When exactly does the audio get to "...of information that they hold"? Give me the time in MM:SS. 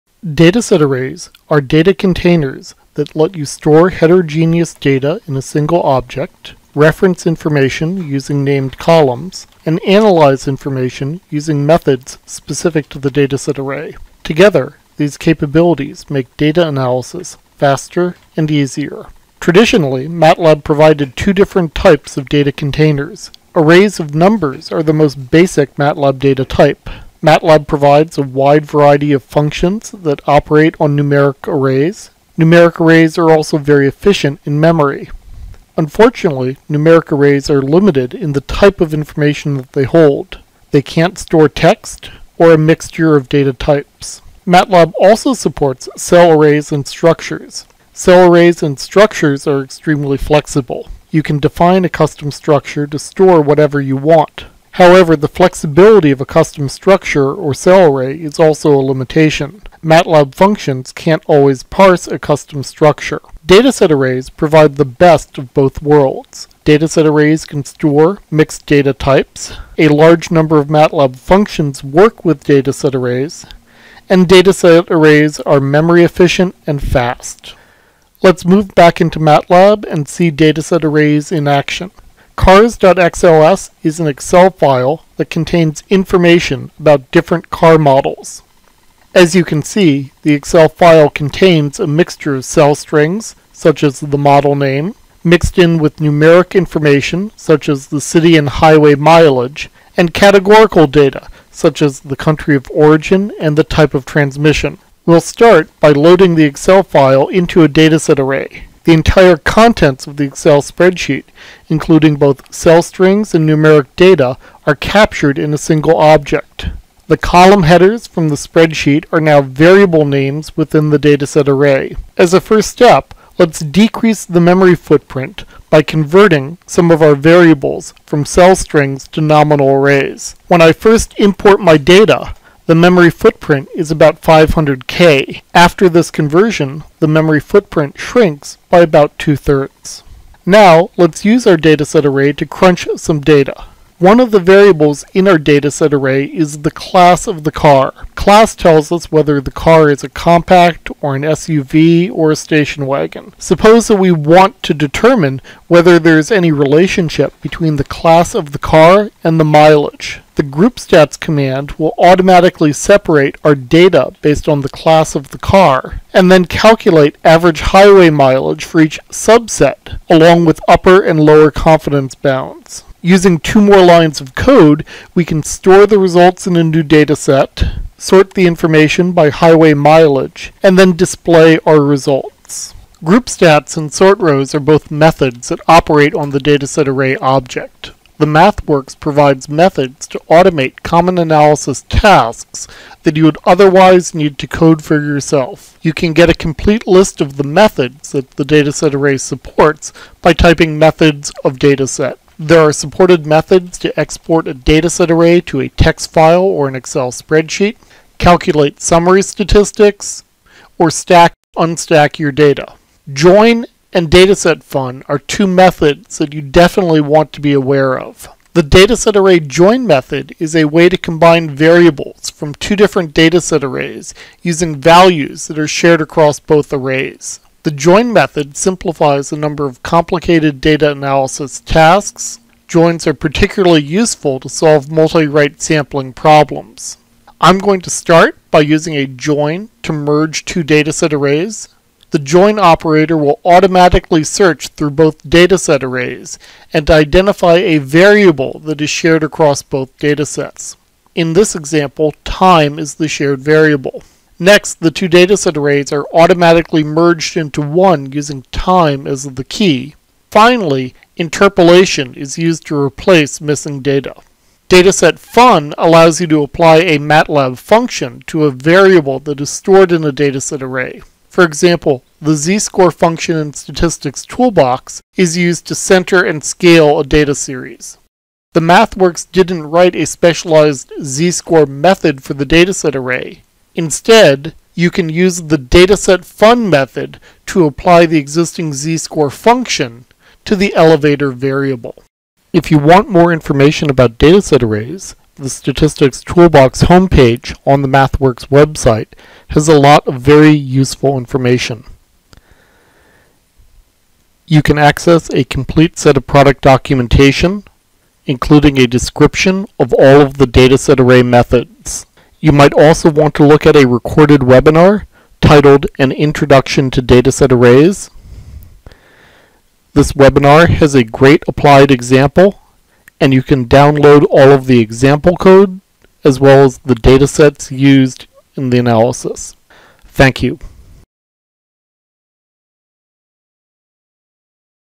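00:38.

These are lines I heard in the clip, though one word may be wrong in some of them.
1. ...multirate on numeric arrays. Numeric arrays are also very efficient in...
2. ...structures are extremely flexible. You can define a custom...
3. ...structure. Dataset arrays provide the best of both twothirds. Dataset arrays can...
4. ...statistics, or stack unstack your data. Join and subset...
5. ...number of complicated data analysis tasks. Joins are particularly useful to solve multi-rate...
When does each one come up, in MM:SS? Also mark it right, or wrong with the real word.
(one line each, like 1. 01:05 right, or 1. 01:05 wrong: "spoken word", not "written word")
1. 00:30 wrong: "operate", not "multirate"
2. 00:48 right
3. 01:02 wrong: "worlds", not "twothirds"
4. 03:29 wrong: "dataset", not "subset"
5. 03:49 right.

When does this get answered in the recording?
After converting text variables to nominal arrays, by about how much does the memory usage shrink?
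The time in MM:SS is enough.
02:19.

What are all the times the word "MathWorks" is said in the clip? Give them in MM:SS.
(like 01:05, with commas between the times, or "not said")
03:08, 04:38, 04:57.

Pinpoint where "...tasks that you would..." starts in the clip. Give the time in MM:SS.
03:11.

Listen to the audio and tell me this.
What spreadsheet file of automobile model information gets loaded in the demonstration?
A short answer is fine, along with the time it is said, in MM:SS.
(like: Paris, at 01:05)
Cars.xls, at 01:22.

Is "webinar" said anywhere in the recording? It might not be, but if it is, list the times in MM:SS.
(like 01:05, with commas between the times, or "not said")
05:14, 05:20.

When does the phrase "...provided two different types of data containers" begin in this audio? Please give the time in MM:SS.
00:20.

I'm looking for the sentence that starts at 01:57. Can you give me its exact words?
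The column headers from the spreadsheet are now variable names within the dataset array.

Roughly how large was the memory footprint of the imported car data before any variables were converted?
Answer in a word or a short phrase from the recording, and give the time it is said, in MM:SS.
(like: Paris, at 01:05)
500k, at 02:14.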